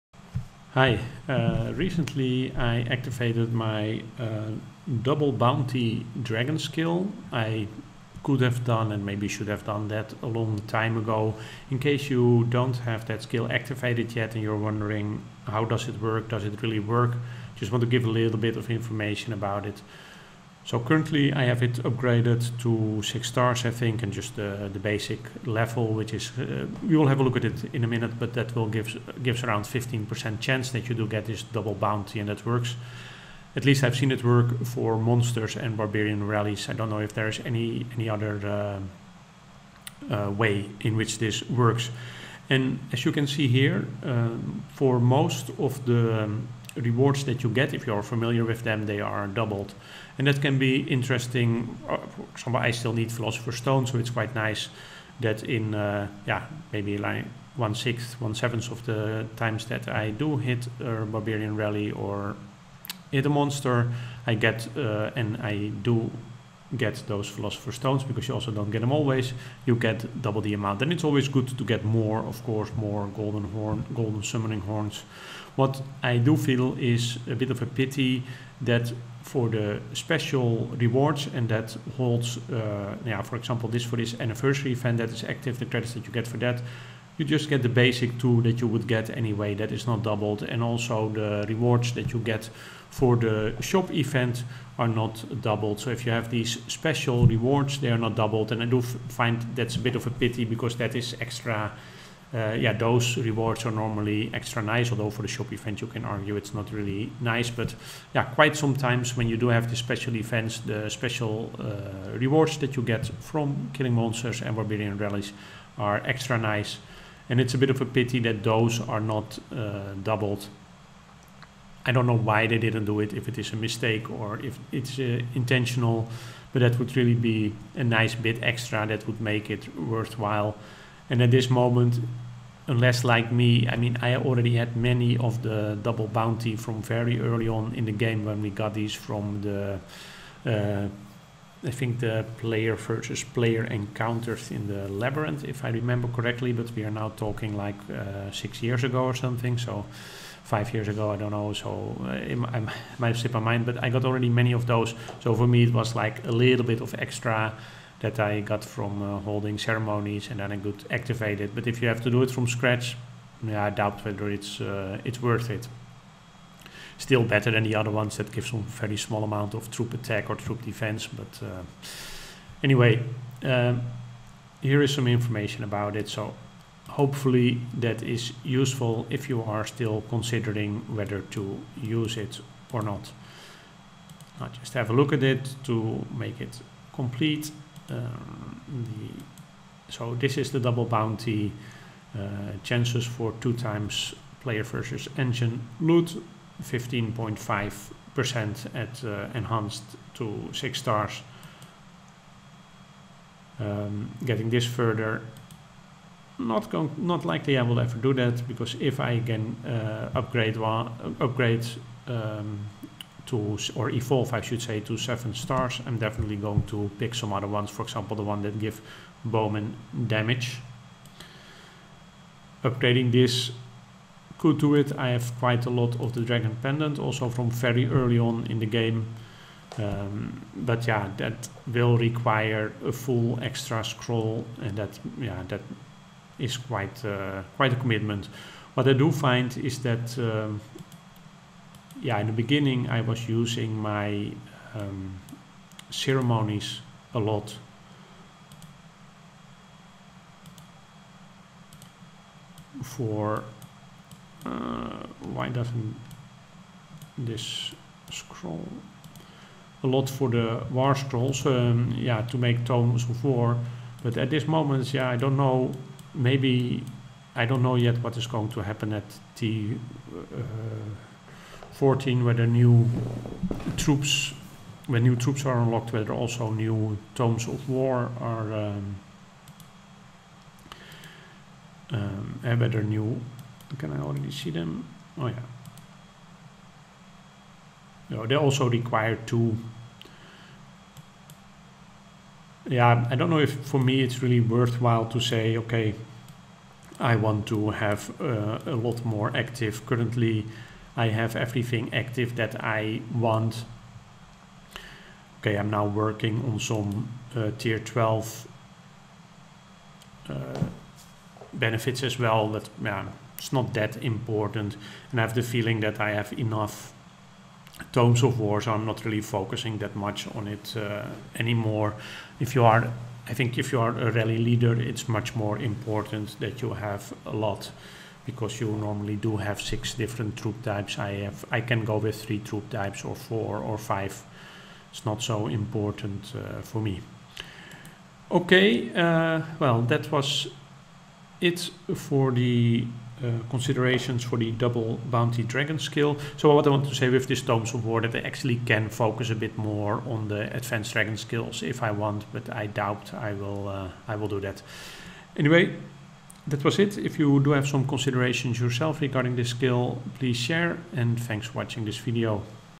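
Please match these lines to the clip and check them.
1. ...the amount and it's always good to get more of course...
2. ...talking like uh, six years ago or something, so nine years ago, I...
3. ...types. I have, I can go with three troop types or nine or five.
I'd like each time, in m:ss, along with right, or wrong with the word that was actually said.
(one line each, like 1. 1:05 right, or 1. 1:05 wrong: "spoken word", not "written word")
1. 1:10 right
2. 2:27 wrong: "five", not "nine"
3. 5:30 wrong: "four", not "nine".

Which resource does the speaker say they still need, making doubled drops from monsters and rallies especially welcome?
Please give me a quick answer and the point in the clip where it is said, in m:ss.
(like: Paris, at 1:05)
Philosopher's Stone, at 0:53.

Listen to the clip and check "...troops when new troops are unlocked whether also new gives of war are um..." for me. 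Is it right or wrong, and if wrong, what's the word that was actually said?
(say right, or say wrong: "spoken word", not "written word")
wrong: "tomes", not "gives".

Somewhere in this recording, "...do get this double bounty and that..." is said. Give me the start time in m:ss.
0:30.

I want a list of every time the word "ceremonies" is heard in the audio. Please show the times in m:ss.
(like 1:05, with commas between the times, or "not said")
2:39, 4:05.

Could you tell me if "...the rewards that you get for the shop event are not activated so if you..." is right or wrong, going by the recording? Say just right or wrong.
wrong.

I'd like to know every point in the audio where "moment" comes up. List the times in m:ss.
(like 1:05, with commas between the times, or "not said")
2:11, 4:24.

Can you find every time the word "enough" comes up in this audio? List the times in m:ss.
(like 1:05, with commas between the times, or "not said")
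5:16.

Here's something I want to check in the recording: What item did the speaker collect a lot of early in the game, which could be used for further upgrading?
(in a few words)
Dragon Pendant.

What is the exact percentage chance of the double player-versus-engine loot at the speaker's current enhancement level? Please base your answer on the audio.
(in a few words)
15.5%.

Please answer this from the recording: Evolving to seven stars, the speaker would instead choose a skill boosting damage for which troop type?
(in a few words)
Bowman.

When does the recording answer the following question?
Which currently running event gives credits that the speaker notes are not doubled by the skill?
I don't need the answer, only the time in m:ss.
1:24.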